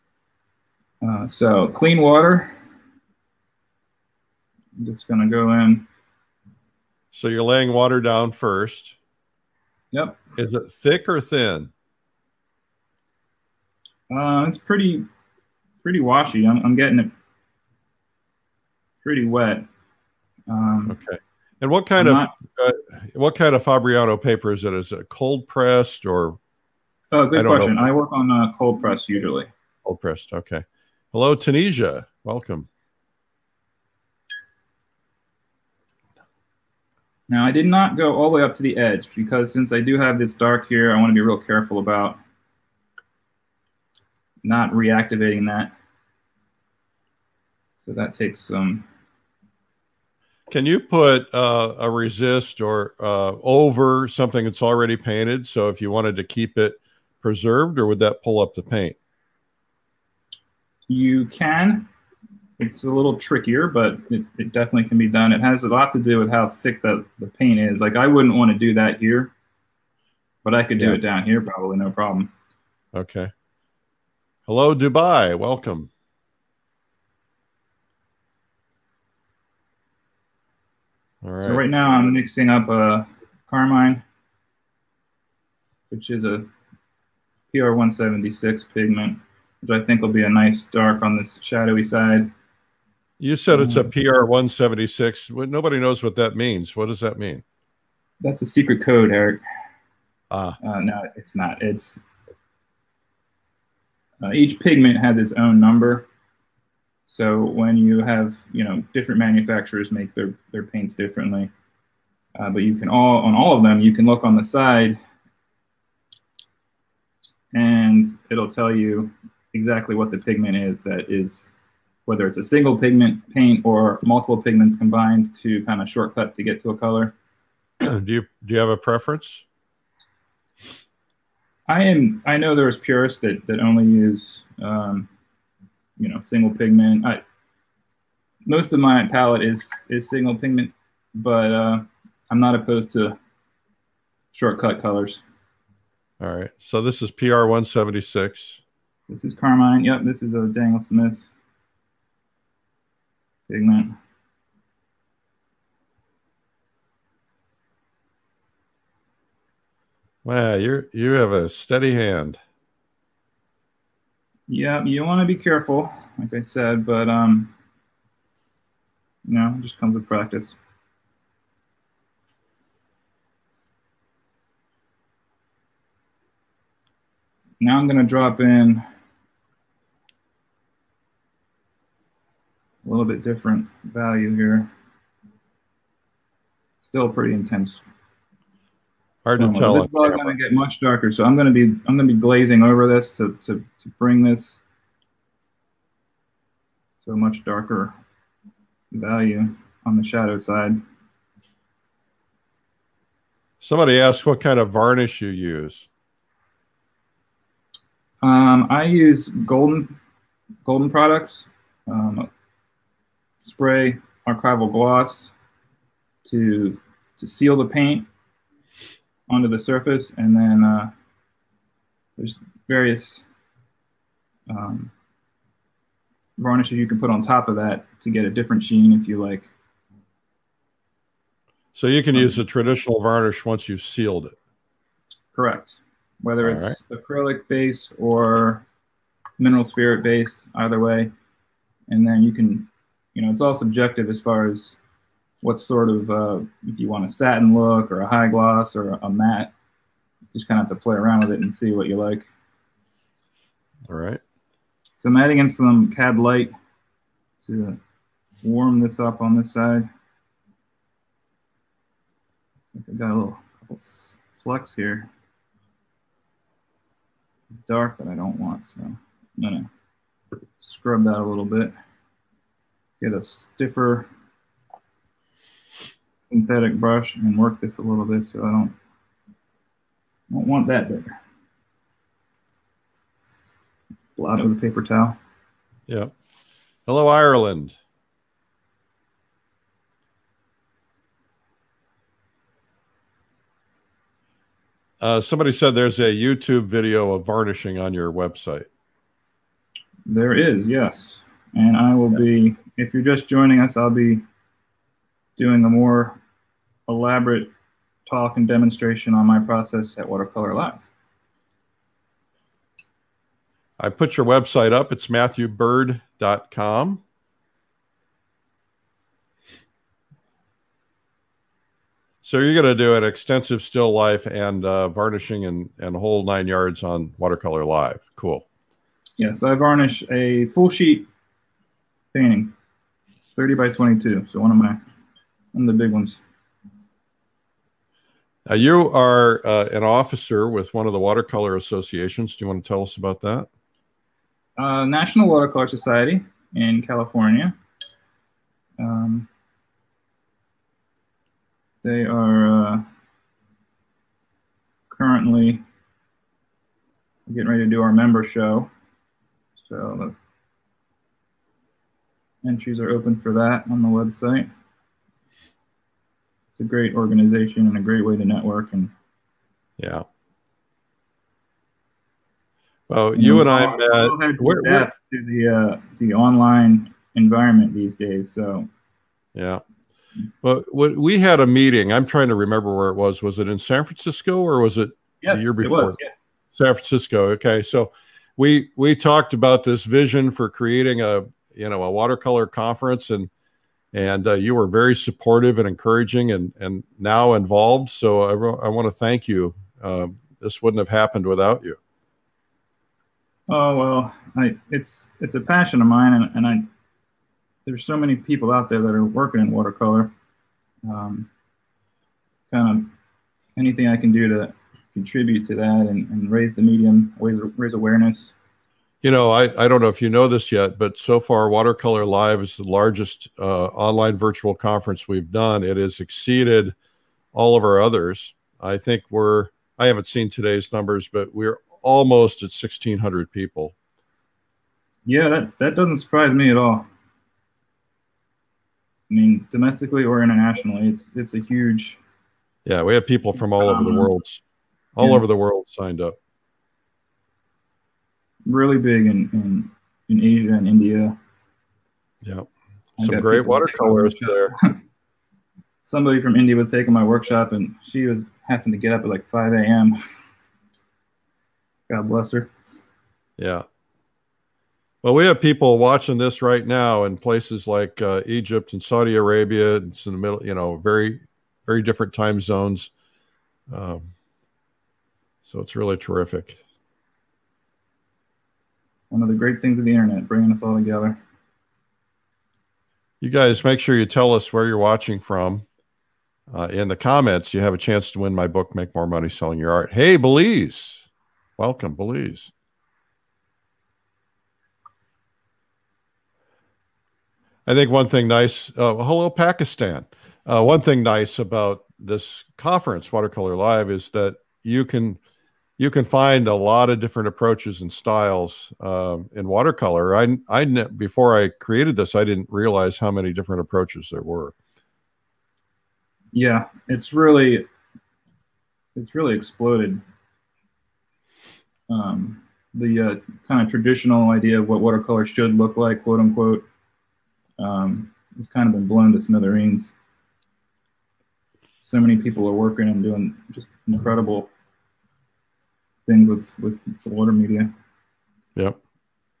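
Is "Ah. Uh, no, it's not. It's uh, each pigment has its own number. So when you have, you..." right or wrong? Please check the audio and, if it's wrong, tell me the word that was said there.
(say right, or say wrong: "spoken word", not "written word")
right.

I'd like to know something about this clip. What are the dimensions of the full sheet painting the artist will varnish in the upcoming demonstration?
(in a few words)
30 by 22.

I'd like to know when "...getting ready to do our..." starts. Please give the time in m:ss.
5:57.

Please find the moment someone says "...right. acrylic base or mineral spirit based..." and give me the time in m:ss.
3:56.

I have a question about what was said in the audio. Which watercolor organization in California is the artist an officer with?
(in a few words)
National Watercolor Society.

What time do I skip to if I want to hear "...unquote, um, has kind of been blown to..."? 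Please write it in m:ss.
8:46.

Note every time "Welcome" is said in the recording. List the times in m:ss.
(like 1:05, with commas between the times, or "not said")
0:32, 1:15, 8:11.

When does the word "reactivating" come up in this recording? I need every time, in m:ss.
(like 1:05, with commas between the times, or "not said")
0:44.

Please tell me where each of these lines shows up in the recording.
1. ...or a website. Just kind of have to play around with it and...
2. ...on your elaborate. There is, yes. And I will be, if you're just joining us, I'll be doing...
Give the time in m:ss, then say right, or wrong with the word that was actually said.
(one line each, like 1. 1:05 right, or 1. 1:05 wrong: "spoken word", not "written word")
1. 4:08 wrong: "matte", not "website"
2. 4:57 wrong: "website", not "elaborate".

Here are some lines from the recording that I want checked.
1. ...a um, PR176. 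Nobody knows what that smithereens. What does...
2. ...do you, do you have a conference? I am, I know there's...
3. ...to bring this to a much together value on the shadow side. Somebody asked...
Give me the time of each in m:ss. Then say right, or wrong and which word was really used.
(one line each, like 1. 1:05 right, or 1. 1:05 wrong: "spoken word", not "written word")
1. 1:33 wrong: "means", not "smithereens"
2. 2:07 wrong: "preference", not "conference"
3. 3:13 wrong: "darker", not "together".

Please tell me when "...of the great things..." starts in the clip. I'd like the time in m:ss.
7:59.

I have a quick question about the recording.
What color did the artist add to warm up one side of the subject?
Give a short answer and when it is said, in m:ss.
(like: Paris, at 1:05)
Cad light, at 4:15.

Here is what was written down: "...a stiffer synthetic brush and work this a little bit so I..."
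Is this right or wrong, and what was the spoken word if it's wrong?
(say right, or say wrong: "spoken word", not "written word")
right.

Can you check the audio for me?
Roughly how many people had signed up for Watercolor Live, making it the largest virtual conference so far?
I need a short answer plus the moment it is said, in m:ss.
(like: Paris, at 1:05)
1,600, at 7:12.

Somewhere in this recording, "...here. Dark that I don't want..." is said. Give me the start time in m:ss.
4:24.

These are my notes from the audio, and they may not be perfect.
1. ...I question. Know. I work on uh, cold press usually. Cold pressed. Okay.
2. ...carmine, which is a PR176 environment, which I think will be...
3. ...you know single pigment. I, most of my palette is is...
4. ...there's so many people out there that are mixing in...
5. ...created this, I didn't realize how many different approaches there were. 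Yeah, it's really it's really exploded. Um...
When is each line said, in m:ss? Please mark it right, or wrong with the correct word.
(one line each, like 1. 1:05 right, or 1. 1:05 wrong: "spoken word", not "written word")
1. 0:27 right
2. 1:23 wrong: "pigment", not "environment"
3. 2:16 right
4. 6:47 wrong: "working", not "mixing"
5. 8:31 right.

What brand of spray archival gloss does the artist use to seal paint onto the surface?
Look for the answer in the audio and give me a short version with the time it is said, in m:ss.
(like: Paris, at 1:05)
Golden, at 3:29.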